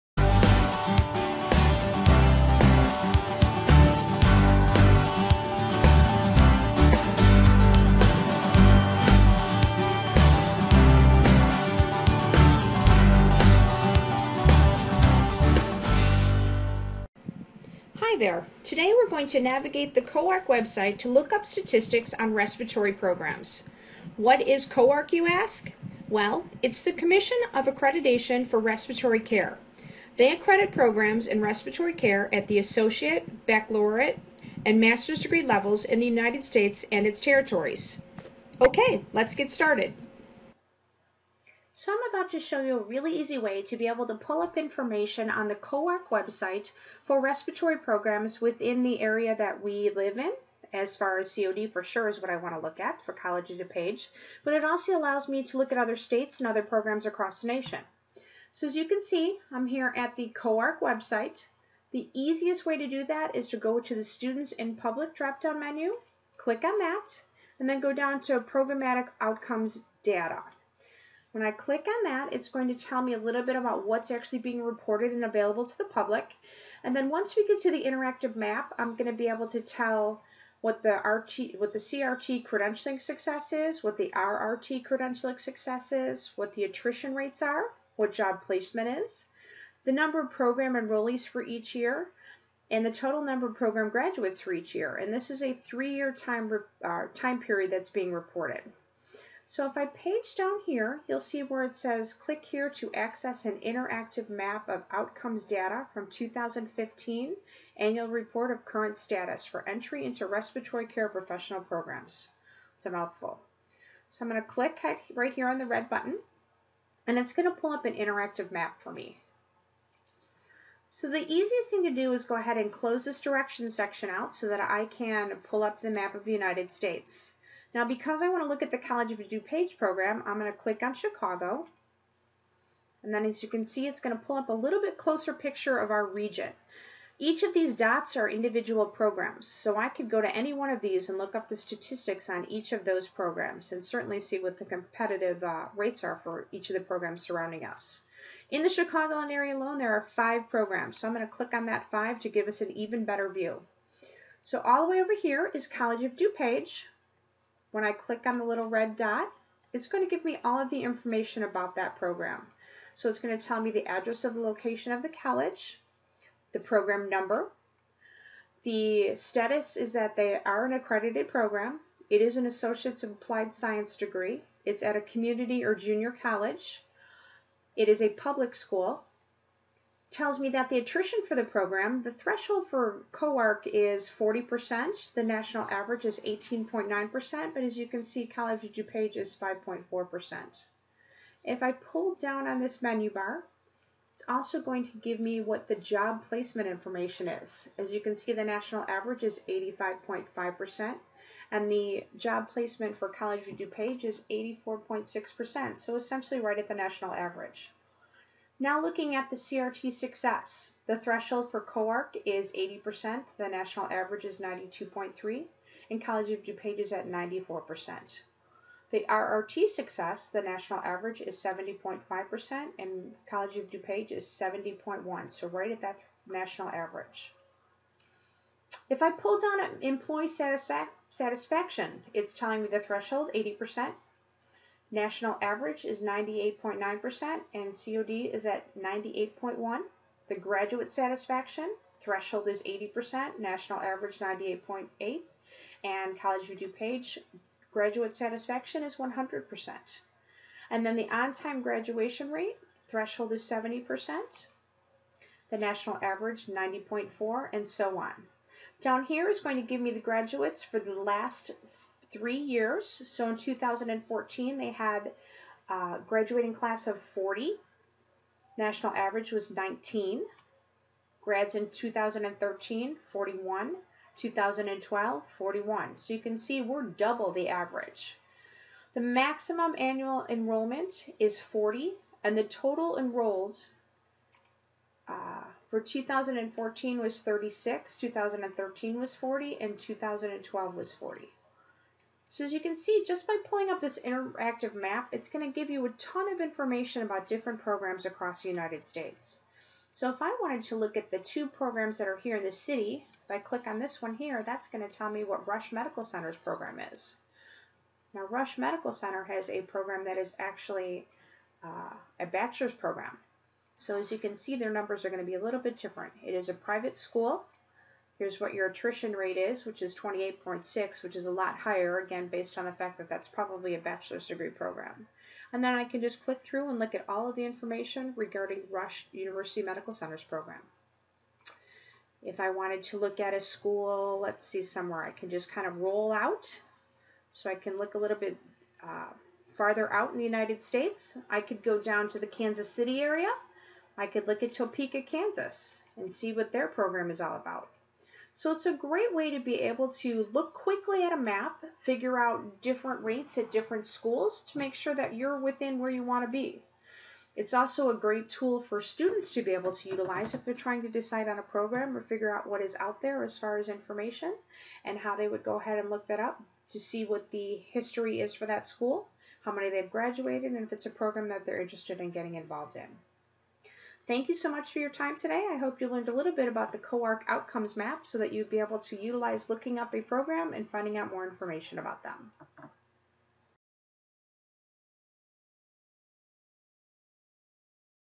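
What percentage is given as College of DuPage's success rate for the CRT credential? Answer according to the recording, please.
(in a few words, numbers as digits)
94%.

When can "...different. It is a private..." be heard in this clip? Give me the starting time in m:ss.
5:15.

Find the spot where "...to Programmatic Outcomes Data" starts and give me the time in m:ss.
1:08.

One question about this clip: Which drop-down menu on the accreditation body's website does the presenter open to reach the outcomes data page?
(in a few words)
Students in Public.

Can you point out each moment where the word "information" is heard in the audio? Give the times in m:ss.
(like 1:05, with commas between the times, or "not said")
0:44, 2:40, 3:16, 4:56, 5:27, 6:03, 6:21.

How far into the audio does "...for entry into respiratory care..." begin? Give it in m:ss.
1:49.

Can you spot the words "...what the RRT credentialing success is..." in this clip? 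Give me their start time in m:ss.
1:23.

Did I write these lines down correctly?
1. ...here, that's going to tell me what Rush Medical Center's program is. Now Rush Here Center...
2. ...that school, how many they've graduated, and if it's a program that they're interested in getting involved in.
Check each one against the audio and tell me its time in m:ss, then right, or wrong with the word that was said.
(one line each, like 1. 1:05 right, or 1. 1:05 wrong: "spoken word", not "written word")
1. 5:04 wrong: "Medical", not "Here"
2. 6:08 right.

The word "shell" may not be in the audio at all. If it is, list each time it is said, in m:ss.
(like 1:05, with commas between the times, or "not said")
not said.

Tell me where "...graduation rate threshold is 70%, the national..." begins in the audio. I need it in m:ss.
4:11.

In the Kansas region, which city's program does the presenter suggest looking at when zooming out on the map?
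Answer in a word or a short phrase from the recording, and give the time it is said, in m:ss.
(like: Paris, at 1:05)
Topeka, at 5:44.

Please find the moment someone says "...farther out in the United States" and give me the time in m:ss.
5:39.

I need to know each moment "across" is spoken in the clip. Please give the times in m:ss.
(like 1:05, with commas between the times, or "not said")
0:57, 4:58.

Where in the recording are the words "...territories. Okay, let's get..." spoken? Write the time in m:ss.
0:37.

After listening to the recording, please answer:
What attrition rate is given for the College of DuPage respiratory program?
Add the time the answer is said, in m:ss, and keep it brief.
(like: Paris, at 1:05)
5.4%, at 3:09.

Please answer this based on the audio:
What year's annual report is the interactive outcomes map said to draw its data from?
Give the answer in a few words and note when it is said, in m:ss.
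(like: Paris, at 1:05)
2015, at 1:46.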